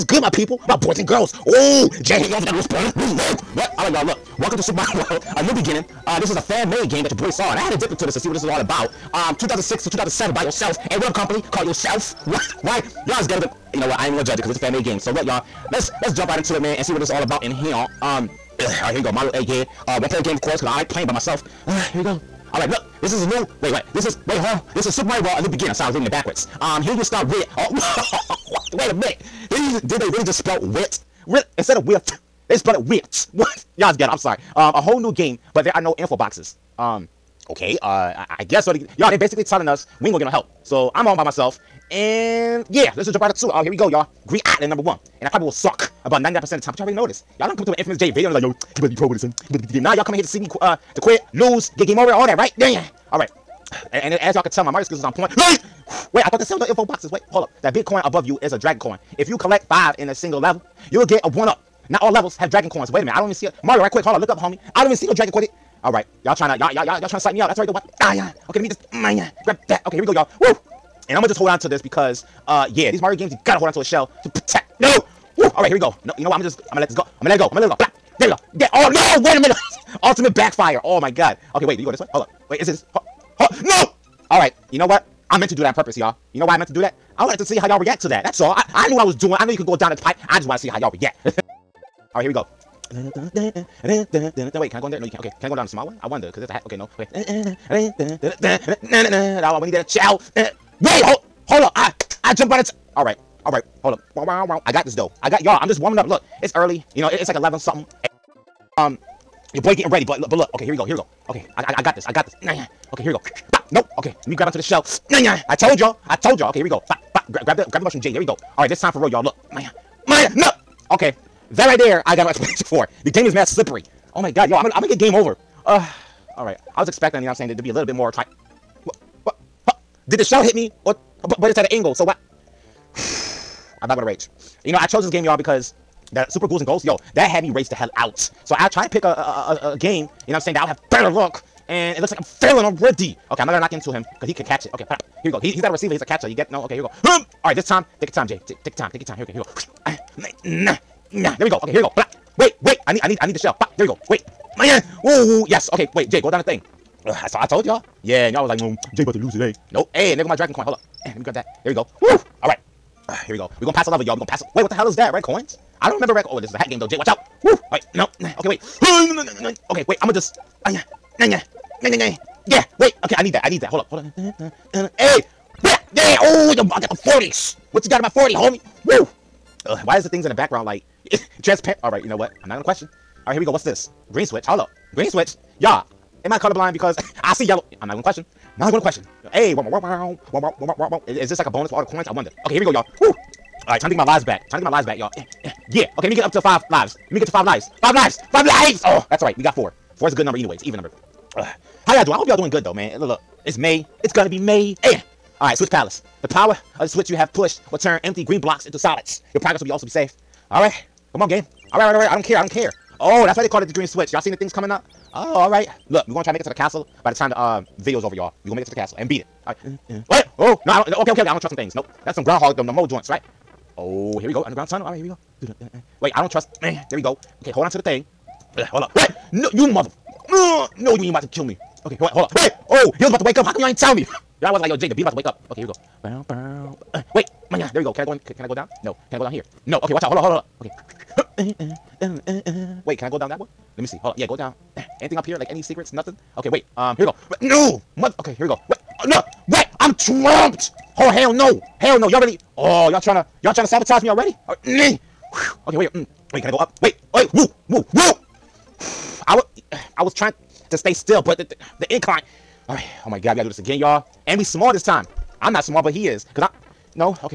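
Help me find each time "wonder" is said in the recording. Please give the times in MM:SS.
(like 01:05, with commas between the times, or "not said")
01:36, 03:12.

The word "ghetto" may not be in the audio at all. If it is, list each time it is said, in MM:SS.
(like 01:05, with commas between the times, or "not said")
00:13, 00:33.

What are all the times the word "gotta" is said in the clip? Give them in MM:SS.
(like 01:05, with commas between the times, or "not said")
01:13, 04:23.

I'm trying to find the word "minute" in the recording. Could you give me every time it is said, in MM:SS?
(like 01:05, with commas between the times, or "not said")
00:28, 01:03, 01:19.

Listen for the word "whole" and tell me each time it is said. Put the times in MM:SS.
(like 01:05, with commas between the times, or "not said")
00:34.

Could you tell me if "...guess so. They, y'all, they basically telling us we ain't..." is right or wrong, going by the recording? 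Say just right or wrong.
right.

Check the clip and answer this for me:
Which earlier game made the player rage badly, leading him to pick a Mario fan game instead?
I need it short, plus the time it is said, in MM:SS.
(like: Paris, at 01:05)
Super Ghouls and Ghosts, at 02:16.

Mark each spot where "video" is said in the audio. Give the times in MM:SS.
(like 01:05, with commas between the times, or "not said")
00:48, 03:37.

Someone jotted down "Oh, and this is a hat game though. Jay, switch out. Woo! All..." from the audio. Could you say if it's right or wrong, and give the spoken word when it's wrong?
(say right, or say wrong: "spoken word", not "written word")
wrong: "watch", not "switch".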